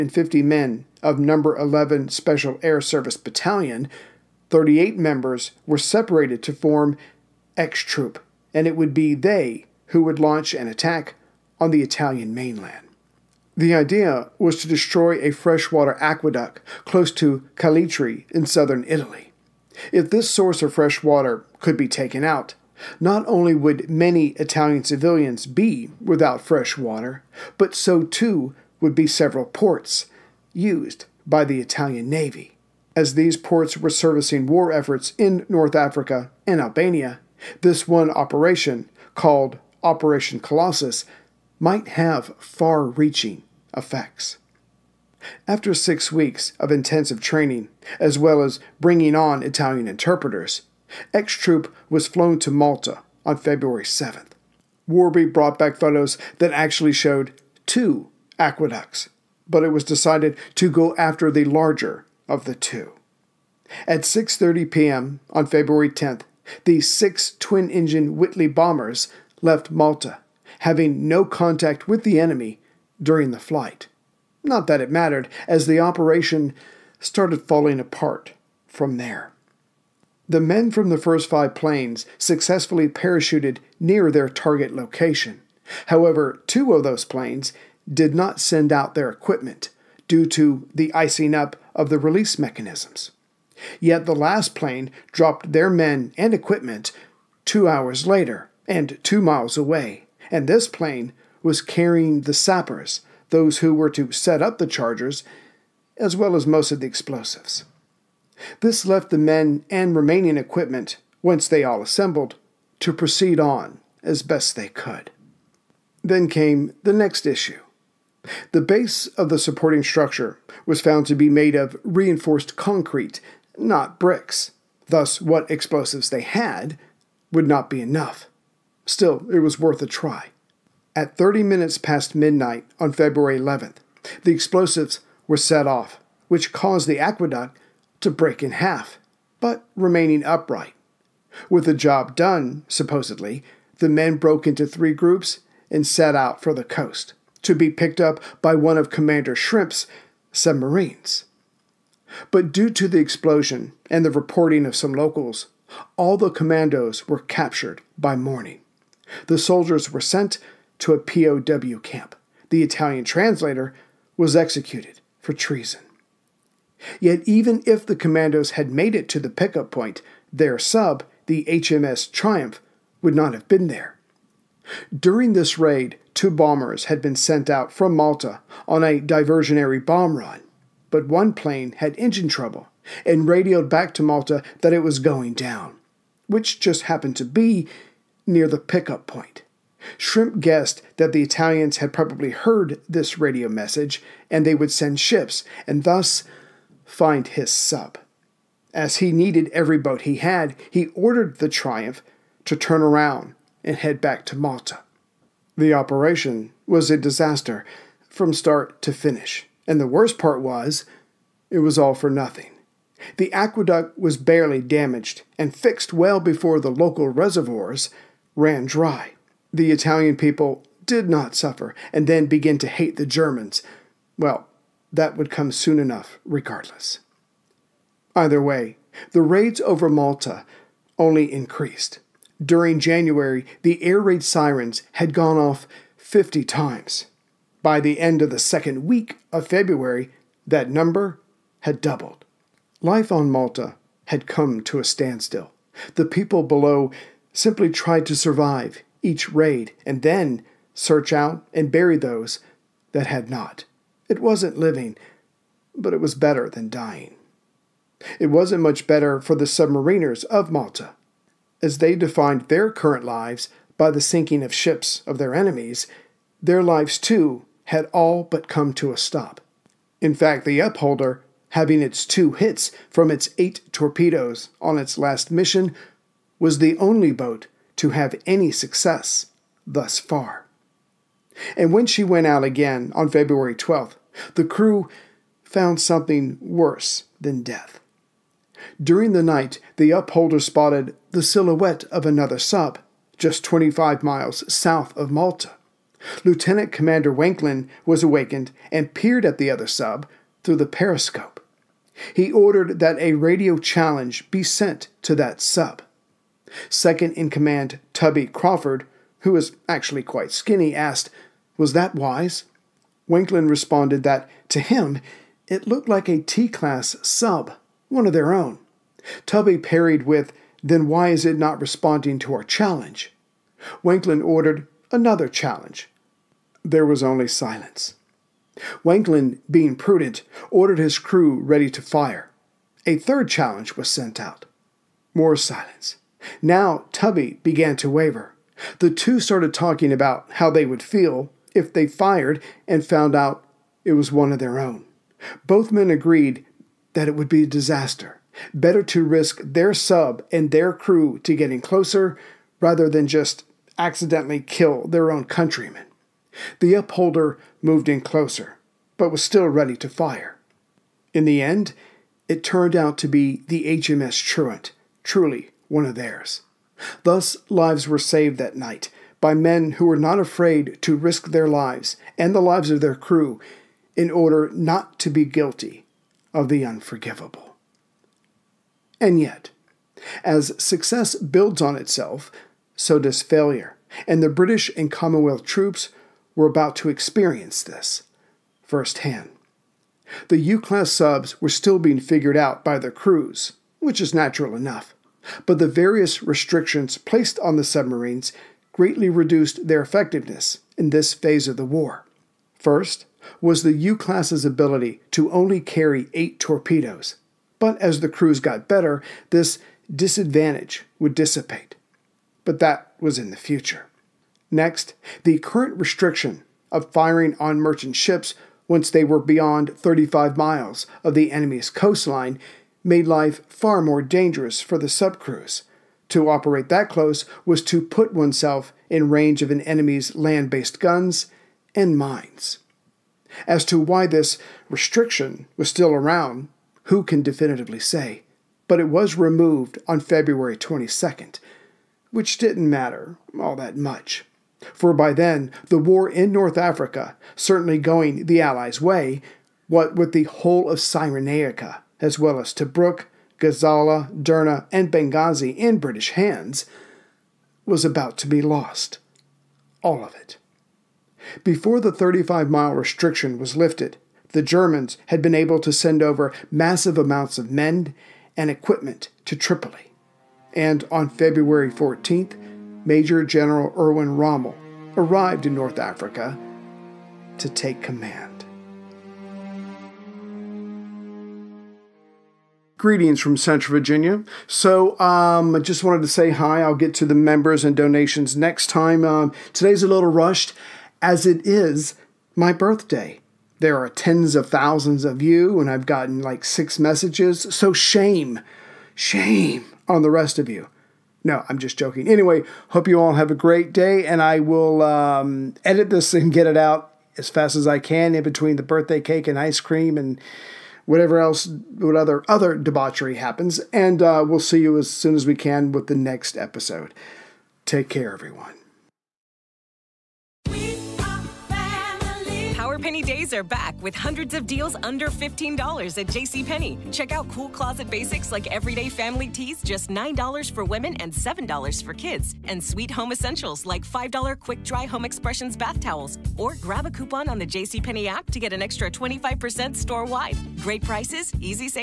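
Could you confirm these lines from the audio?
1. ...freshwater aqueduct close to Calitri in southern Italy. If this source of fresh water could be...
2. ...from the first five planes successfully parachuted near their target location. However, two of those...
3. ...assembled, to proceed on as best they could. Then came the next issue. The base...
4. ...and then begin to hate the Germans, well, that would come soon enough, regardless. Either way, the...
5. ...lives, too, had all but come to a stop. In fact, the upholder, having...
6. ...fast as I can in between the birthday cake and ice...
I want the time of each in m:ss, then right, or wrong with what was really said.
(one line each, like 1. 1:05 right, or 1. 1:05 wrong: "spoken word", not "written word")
1. 0:15 right
2. 1:20 right
3. 1:51 right
4. 3:41 right
5. 4:26 right
6. 8:27 right.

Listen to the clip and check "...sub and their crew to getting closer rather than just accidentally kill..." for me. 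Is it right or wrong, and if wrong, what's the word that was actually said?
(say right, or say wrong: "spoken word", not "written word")
right.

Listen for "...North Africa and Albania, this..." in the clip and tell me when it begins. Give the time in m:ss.
0:35.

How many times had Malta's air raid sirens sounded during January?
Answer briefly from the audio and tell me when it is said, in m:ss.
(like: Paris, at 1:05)
50, at 3:55.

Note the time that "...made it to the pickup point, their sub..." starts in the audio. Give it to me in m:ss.
2:48.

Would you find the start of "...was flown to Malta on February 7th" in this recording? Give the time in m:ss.
0:51.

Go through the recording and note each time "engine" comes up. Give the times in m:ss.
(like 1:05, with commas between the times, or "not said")
1:07, 3:01.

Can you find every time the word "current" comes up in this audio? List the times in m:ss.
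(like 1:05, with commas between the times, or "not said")
4:22, 6:55.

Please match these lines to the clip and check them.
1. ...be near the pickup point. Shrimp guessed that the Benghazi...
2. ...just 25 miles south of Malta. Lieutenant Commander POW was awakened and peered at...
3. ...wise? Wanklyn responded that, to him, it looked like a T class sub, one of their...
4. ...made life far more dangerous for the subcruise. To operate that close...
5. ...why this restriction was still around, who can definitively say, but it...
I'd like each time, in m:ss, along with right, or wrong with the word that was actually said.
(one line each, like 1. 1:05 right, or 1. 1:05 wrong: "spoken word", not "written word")
1. 3:07 wrong: "Italians", not "Benghazi"
2. 4:53 wrong: "Wanklyn", not "POW"
3. 5:11 right
4. 7:02 right
5. 7:13 right.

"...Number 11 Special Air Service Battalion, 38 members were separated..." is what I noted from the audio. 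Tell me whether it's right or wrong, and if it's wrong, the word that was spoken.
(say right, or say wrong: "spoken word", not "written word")
right.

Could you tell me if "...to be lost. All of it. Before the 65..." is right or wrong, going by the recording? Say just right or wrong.
wrong.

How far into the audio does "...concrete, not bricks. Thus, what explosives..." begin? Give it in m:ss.
2:02.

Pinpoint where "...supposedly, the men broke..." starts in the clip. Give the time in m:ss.
2:22.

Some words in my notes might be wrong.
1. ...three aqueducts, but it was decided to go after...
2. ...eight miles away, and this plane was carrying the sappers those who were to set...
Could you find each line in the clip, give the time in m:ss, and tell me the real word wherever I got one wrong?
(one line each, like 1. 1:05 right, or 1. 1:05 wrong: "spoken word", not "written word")
1. 0:57 wrong: "two", not "three"
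2. 1:39 wrong: "two", not "eight".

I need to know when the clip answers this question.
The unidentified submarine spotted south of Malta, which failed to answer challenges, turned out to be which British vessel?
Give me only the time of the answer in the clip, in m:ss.
6:03.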